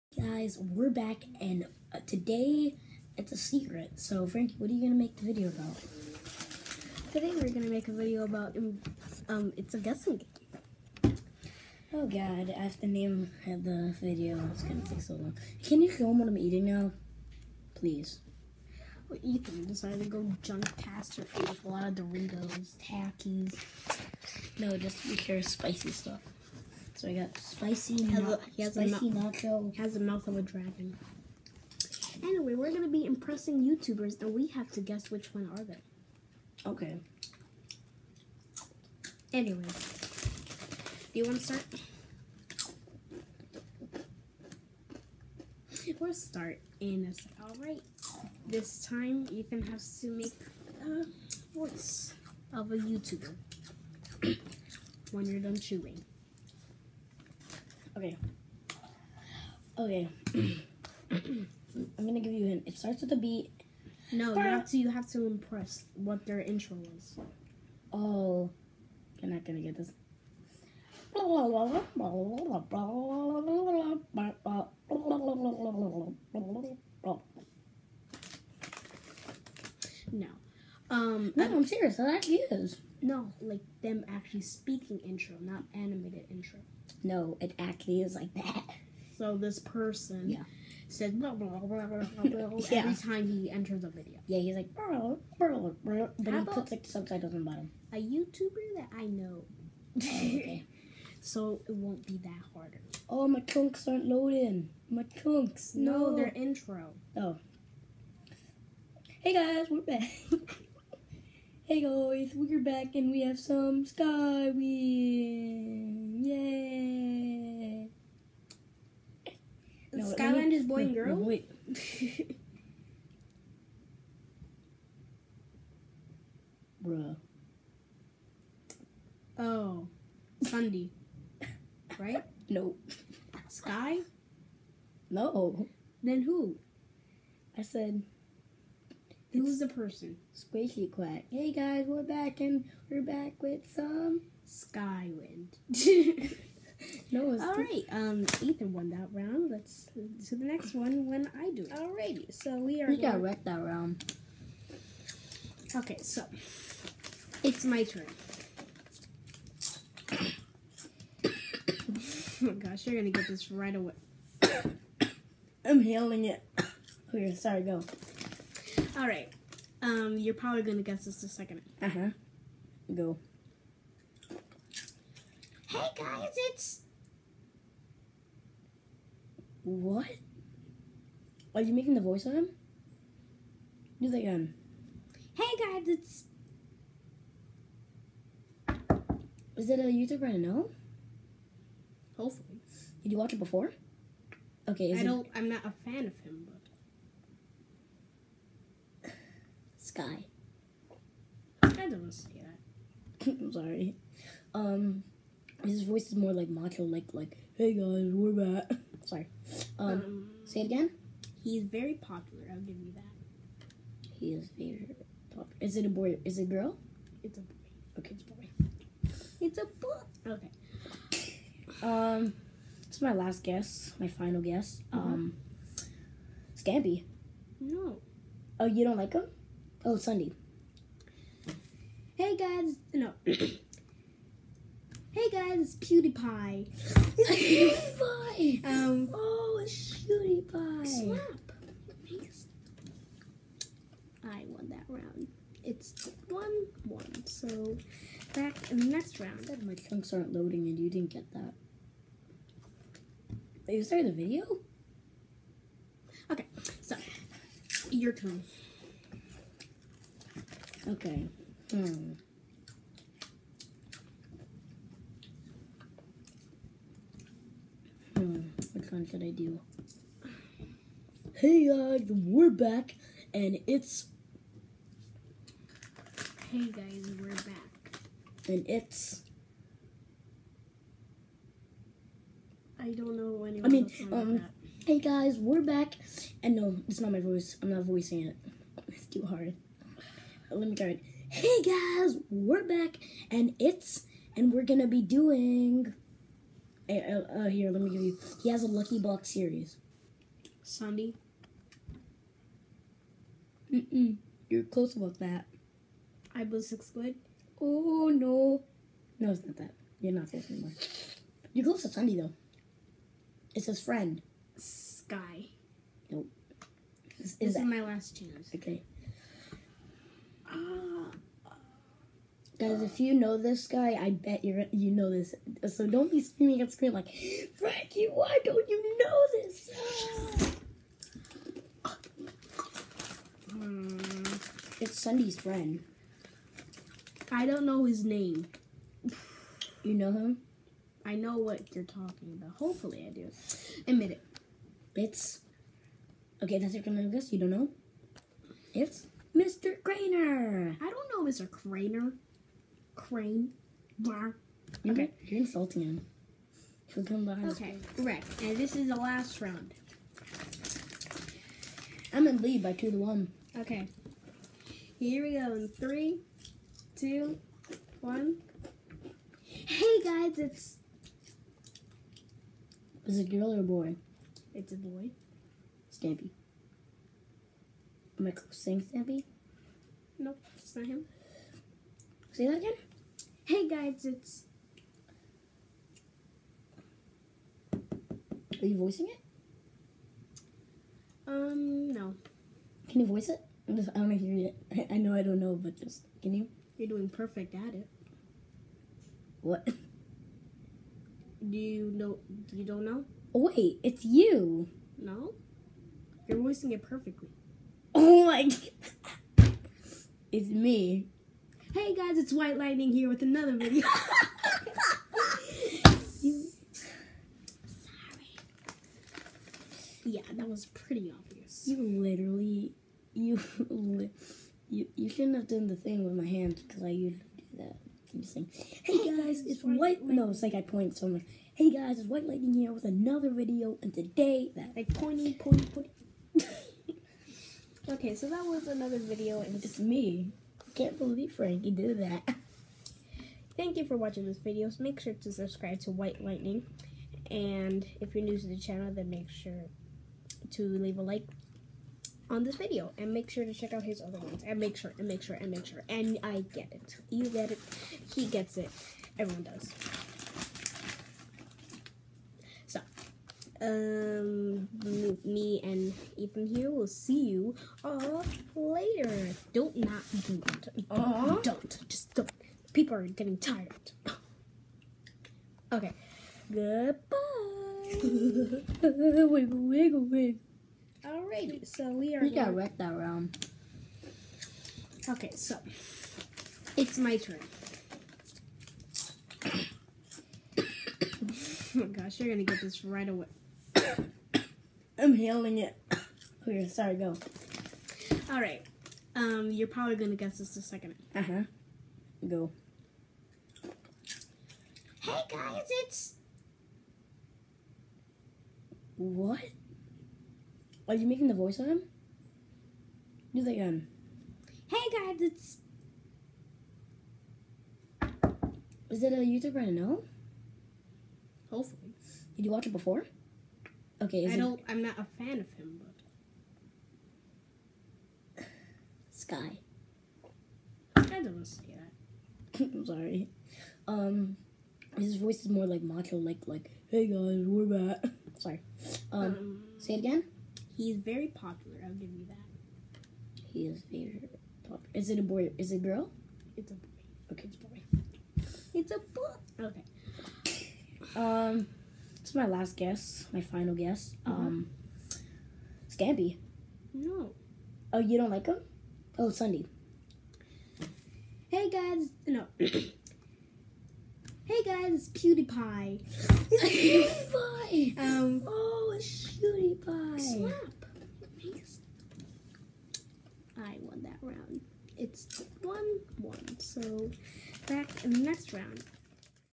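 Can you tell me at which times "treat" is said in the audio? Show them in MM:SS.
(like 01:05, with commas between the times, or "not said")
not said.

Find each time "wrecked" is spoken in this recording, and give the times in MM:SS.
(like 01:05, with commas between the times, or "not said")
02:33, 08:02.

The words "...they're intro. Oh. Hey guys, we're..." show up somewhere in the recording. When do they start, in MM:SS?
01:46.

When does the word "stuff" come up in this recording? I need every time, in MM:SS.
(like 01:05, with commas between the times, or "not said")
00:25.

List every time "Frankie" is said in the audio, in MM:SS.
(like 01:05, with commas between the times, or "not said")
00:04, 05:27, 07:21.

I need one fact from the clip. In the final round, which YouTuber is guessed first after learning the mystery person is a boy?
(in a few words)
Stampy.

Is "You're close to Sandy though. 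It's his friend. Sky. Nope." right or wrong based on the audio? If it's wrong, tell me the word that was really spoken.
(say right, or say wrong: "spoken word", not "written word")
right.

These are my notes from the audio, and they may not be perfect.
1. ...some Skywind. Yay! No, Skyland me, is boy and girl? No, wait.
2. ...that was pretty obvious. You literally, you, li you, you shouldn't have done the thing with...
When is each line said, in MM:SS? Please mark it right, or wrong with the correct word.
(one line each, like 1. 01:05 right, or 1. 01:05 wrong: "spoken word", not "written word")
1. 01:53 right
2. 07:00 right.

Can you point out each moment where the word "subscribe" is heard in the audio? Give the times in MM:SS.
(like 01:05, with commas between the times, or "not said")
07:25.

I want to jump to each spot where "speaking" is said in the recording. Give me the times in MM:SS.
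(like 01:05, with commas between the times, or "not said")
01:24.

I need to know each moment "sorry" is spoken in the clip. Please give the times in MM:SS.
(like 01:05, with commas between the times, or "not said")
02:47, 03:23, 03:29, 08:16, 08:52, 08:58.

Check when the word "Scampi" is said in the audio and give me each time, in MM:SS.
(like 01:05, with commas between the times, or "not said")
03:46, 09:15.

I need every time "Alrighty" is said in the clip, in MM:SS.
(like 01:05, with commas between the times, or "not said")
02:31, 08:01.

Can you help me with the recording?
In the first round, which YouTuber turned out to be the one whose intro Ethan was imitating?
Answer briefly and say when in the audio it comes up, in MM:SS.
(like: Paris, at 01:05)
Squishy Quack, at 02:20.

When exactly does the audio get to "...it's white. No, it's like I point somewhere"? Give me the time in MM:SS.
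07:09.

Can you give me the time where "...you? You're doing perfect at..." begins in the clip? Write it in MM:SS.
06:36.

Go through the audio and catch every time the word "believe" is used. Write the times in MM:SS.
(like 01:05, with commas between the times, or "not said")
07:20.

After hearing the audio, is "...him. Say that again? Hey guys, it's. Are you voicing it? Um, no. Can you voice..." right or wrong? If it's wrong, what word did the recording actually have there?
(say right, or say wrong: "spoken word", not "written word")
right.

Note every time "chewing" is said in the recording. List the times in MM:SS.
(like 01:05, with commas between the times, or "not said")
00:55.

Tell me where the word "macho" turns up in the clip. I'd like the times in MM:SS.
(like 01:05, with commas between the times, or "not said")
03:26, 08:55.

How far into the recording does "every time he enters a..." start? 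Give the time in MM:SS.
01:32.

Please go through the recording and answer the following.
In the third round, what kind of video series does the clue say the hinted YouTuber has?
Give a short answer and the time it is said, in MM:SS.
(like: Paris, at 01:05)
lucky box series, at 04:58.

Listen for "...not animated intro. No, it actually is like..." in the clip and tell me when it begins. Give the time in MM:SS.
01:25.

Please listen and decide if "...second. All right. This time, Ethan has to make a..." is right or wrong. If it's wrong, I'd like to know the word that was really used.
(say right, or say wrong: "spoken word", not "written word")
right.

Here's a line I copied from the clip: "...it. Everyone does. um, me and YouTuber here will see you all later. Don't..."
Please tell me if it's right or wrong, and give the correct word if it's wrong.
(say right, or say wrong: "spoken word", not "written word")
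wrong: "Ethan", not "YouTuber".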